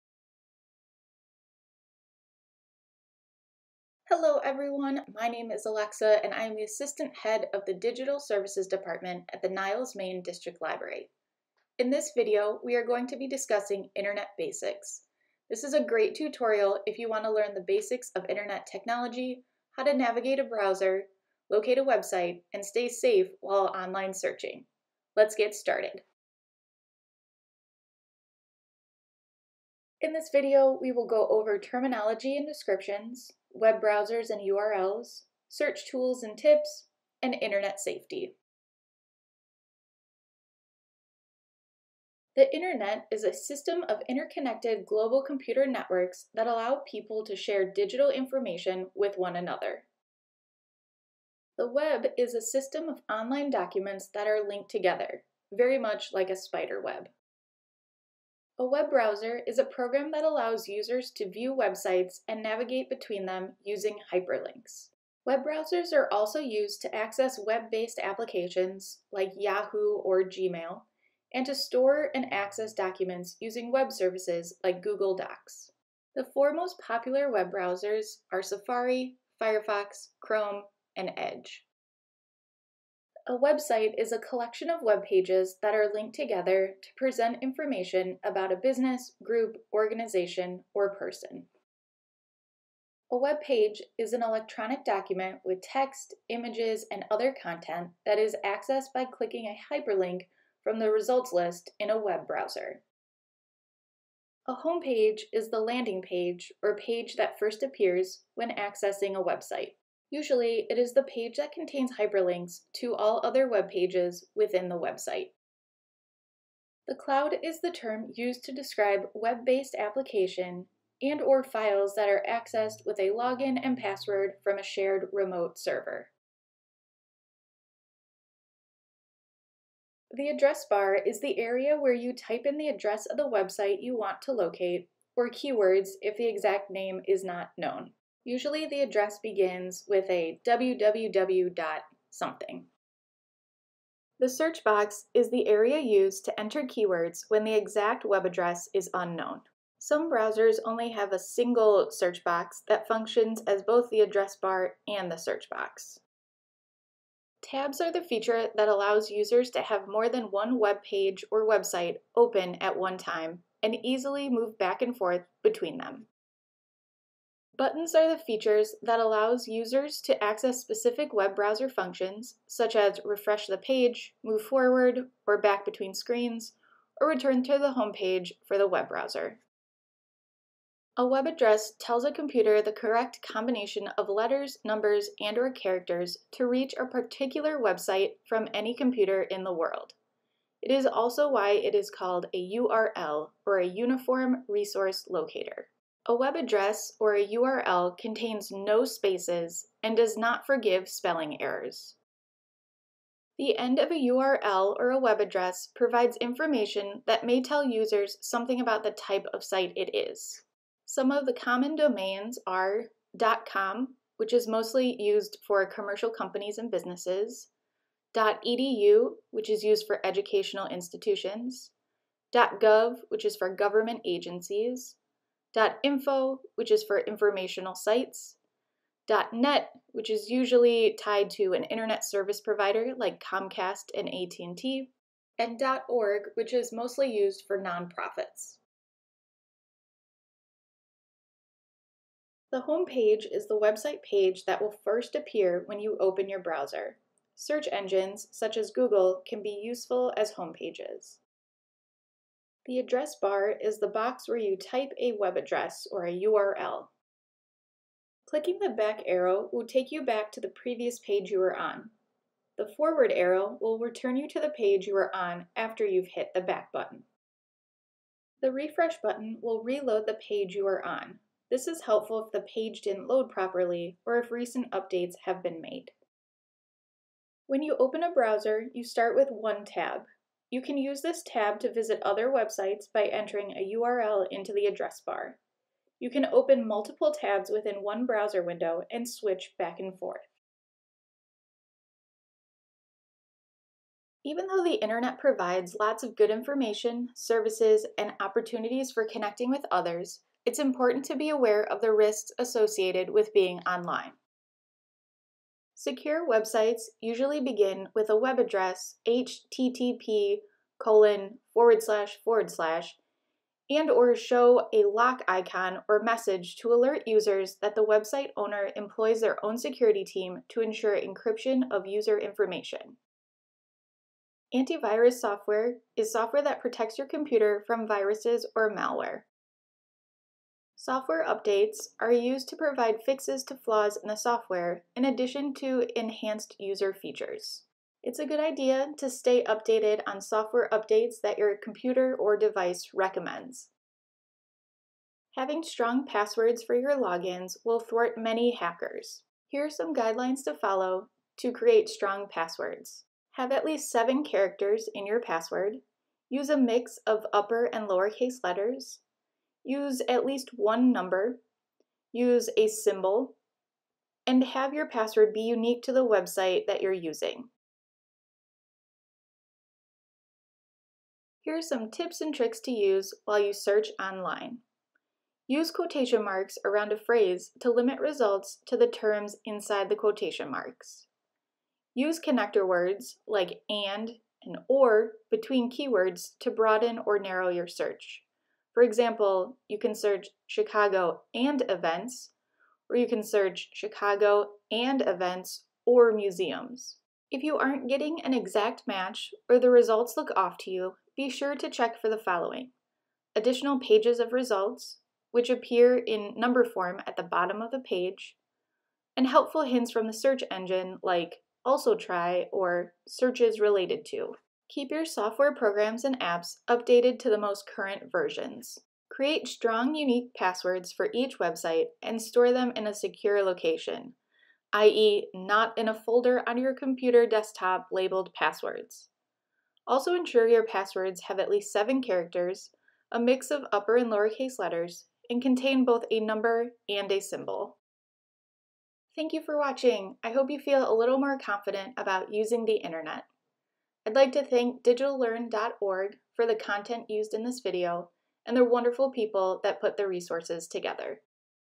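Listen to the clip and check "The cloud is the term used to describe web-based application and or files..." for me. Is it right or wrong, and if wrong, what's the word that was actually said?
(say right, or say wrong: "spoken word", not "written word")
right.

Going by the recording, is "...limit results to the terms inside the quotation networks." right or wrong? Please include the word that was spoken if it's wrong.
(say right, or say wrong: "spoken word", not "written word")
wrong: "marks", not "networks".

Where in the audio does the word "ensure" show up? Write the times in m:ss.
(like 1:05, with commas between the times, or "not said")
5:20, 7:10.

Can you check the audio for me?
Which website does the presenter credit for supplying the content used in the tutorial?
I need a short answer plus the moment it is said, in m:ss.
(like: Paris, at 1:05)
digitallearn.org, at 7:24.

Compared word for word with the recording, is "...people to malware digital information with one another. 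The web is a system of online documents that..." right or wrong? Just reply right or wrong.
wrong.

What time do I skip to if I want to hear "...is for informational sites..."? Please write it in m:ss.
3:46.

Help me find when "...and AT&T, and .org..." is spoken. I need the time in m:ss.
3:53.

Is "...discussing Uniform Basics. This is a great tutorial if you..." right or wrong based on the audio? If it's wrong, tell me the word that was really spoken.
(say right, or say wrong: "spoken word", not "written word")
wrong: "Internet", not "Uniform".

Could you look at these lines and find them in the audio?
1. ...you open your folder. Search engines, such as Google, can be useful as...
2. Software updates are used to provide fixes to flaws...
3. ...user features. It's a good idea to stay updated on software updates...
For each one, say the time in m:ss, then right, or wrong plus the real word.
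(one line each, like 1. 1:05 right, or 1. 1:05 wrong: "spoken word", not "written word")
1. 4:05 wrong: "browser", not "folder"
2. 5:30 right
3. 5:36 right.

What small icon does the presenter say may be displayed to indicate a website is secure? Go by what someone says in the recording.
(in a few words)
lock icon.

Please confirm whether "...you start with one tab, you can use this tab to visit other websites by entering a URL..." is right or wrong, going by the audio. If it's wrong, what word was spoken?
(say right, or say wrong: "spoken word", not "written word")
right.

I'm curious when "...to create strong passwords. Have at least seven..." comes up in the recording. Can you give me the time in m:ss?
5:51.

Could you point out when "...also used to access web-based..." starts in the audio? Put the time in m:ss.
1:06.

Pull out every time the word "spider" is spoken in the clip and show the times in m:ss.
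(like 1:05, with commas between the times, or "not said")
0:56.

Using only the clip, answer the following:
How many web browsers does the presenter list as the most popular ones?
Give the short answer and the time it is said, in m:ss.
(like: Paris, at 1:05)
4, at 1:16.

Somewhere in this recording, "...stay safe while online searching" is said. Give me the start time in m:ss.
0:22.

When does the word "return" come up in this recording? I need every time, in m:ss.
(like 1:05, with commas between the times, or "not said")
2:57, 4:23.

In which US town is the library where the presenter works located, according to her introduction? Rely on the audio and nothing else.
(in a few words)
Niles, Maine.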